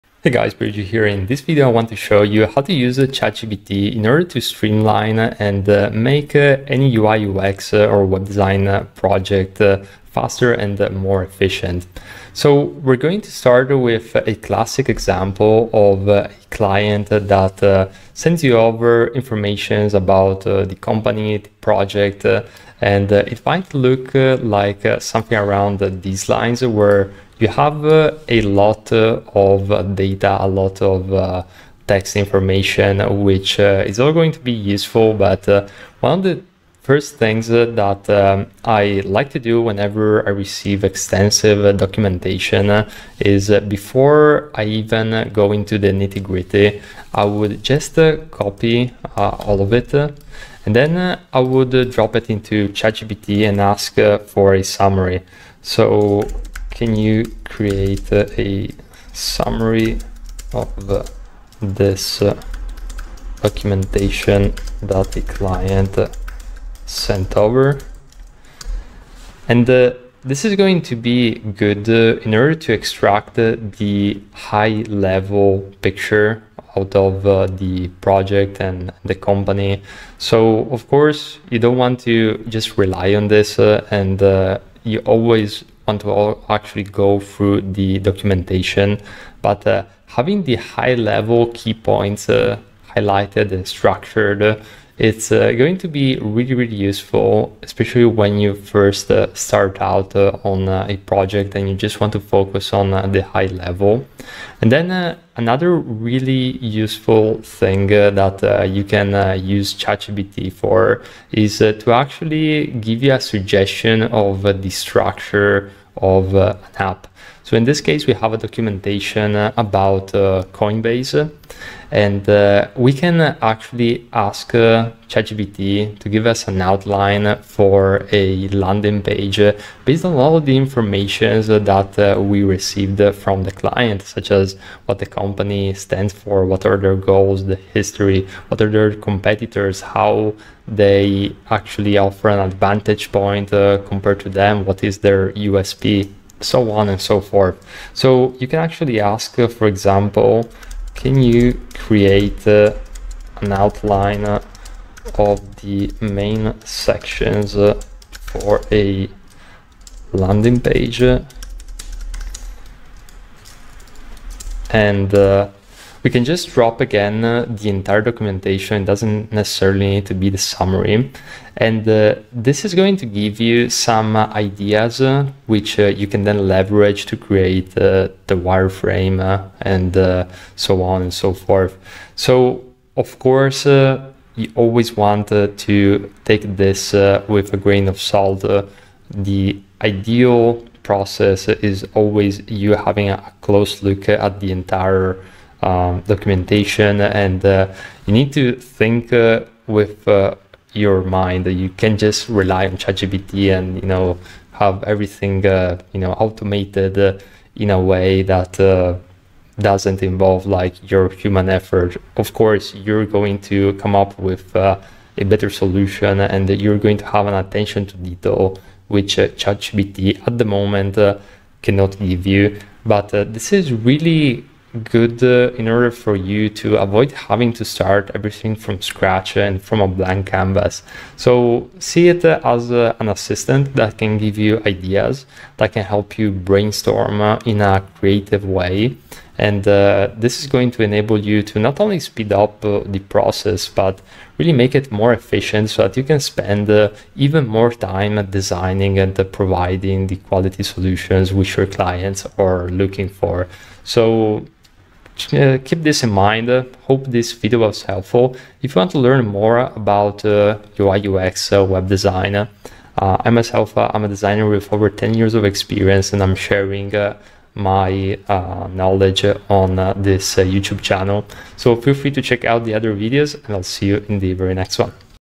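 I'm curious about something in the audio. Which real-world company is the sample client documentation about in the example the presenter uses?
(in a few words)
Coinbase.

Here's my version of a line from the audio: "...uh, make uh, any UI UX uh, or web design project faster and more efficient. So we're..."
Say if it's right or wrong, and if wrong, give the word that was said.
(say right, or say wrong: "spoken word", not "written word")
right.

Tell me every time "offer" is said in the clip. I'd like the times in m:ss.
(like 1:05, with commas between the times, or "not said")
2:21.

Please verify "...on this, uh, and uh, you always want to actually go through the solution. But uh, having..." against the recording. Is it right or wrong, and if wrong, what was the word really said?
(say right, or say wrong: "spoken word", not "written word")
wrong: "documentation", not "solution".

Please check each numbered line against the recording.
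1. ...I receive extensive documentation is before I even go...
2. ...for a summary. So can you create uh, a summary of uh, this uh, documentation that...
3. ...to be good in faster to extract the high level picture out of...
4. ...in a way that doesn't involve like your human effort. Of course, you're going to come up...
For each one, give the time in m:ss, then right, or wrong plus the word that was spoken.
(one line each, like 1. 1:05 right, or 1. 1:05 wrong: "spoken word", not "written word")
1. 0:40 right
2. 0:54 right
3. 1:10 wrong: "order", not "faster"
4. 3:27 right.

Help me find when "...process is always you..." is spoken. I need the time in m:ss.
3:10.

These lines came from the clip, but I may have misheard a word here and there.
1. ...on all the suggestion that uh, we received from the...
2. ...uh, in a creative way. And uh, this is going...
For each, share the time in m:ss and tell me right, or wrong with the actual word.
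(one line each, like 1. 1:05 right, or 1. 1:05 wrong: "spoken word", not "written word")
1. 2:10 wrong: "information", not "suggestion"
2. 3:57 right.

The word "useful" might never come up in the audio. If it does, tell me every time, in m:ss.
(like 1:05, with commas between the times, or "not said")
0:34, 1:36, 1:46.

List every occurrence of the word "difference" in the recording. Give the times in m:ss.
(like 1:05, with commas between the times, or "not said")
not said.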